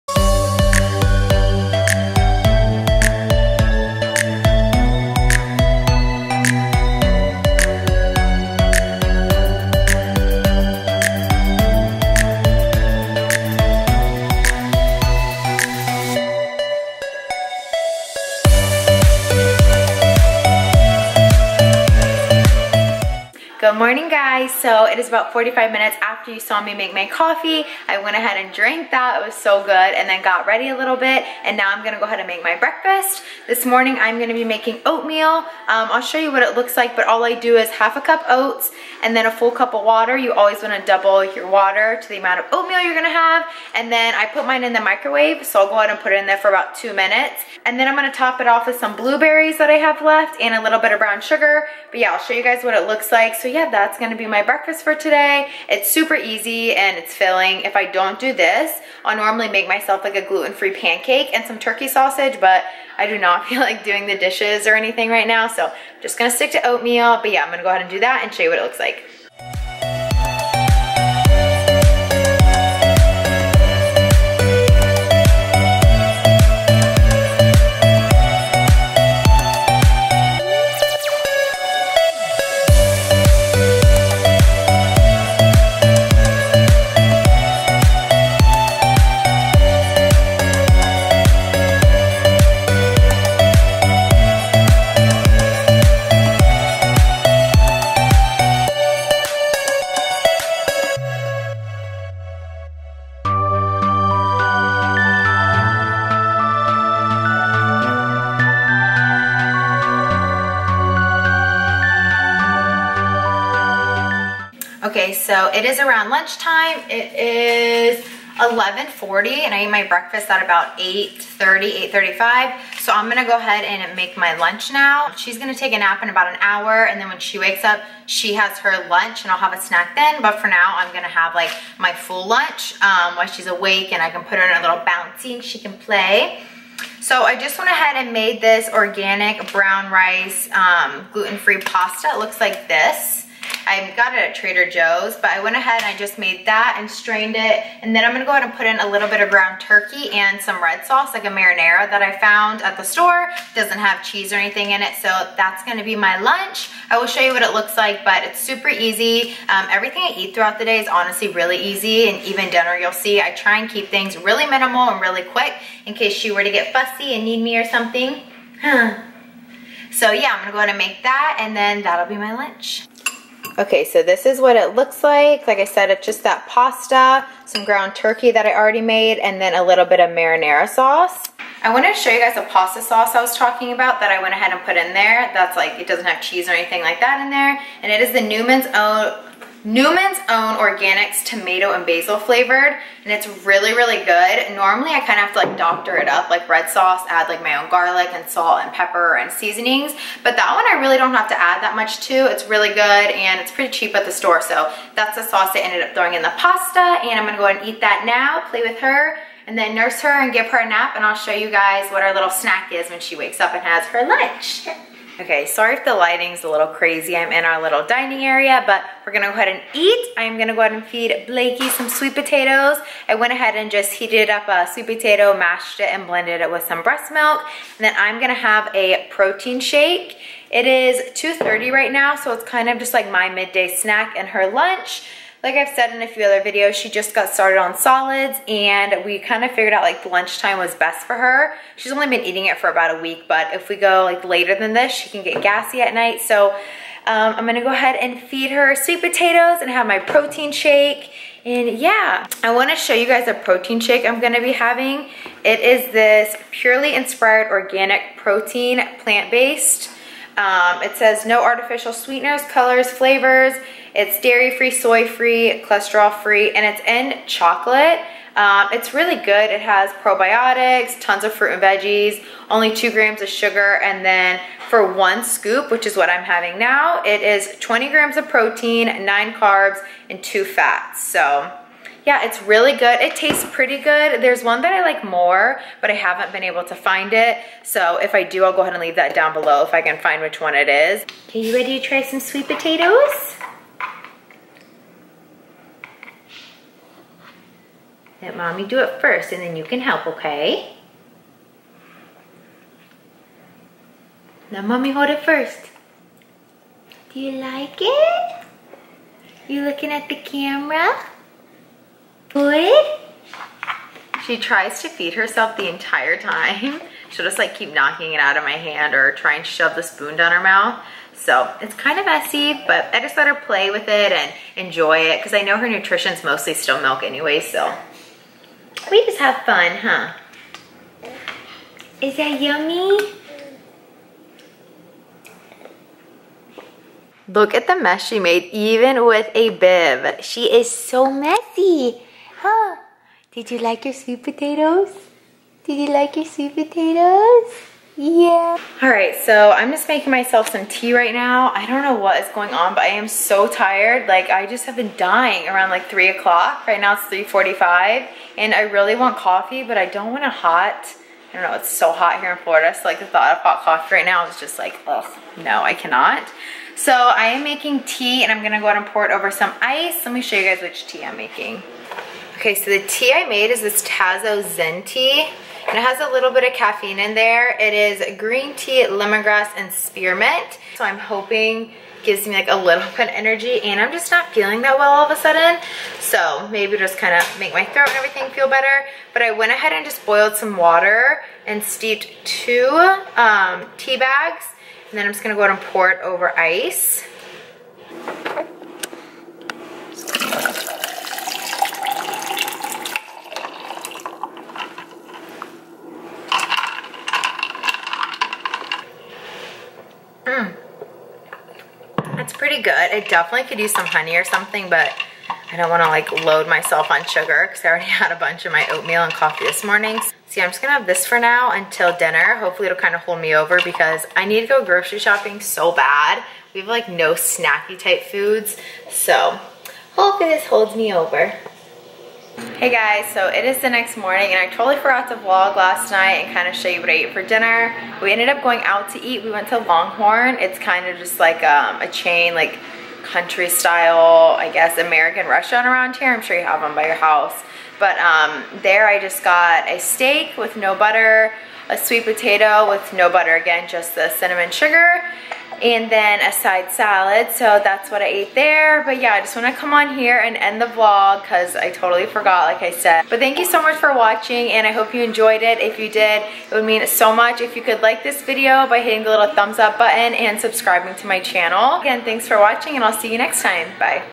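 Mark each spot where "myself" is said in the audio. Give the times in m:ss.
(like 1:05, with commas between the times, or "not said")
0:59, 5:50, 6:56.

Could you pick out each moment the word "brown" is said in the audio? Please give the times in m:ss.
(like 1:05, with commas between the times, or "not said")
0:50, 2:19.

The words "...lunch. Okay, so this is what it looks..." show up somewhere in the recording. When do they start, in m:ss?
2:52.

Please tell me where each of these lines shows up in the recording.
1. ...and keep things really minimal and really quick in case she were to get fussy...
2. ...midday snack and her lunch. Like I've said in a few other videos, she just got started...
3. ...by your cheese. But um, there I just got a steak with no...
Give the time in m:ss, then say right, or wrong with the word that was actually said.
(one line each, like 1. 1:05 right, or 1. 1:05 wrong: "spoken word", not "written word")
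1. 2:43 right
2. 3:53 right
3. 7:26 wrong: "house", not "cheese".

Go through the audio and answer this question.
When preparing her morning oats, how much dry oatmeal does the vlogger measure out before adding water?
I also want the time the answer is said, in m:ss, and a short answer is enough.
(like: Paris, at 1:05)
half a cup, at 0:37.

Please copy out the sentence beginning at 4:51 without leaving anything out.
Okay, you ready to try some sweet potatoes?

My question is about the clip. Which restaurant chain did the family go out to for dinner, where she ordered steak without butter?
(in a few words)
Longhorn.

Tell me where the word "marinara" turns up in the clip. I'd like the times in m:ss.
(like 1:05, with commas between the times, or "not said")
2:31, 3:00.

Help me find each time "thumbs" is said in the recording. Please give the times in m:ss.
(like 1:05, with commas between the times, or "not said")
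7:49.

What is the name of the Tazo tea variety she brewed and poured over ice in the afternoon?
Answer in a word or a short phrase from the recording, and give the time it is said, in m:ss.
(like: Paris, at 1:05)
Zen, at 6:14.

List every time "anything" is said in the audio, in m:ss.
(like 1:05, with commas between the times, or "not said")
1:04, 2:34, 3:06.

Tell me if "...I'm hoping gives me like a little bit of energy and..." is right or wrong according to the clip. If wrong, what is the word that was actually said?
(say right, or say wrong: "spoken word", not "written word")
right.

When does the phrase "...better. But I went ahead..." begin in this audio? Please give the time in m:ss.
6:28.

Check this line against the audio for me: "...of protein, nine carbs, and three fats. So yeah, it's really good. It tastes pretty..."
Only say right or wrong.
wrong.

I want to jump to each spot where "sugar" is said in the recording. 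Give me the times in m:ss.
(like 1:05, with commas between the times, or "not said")
0:51, 4:33, 6:57, 7:34.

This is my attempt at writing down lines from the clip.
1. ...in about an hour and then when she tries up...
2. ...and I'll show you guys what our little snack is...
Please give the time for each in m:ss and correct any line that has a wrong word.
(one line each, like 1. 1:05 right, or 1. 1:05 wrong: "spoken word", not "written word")
1. 2:06 wrong: "wakes", not "tries"
2. 3:30 right.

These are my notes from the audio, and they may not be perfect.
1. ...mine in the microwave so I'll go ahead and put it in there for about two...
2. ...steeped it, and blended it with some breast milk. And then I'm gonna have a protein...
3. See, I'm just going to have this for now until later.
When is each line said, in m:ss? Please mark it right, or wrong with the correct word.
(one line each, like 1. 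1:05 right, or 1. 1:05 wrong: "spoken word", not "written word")
1. 0:44 right
2. 3:45 wrong: "mashed", not "steeped"
3. 7:00 wrong: "dinner", not "later".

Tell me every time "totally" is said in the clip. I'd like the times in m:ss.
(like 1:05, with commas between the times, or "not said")
7:14, 7:41.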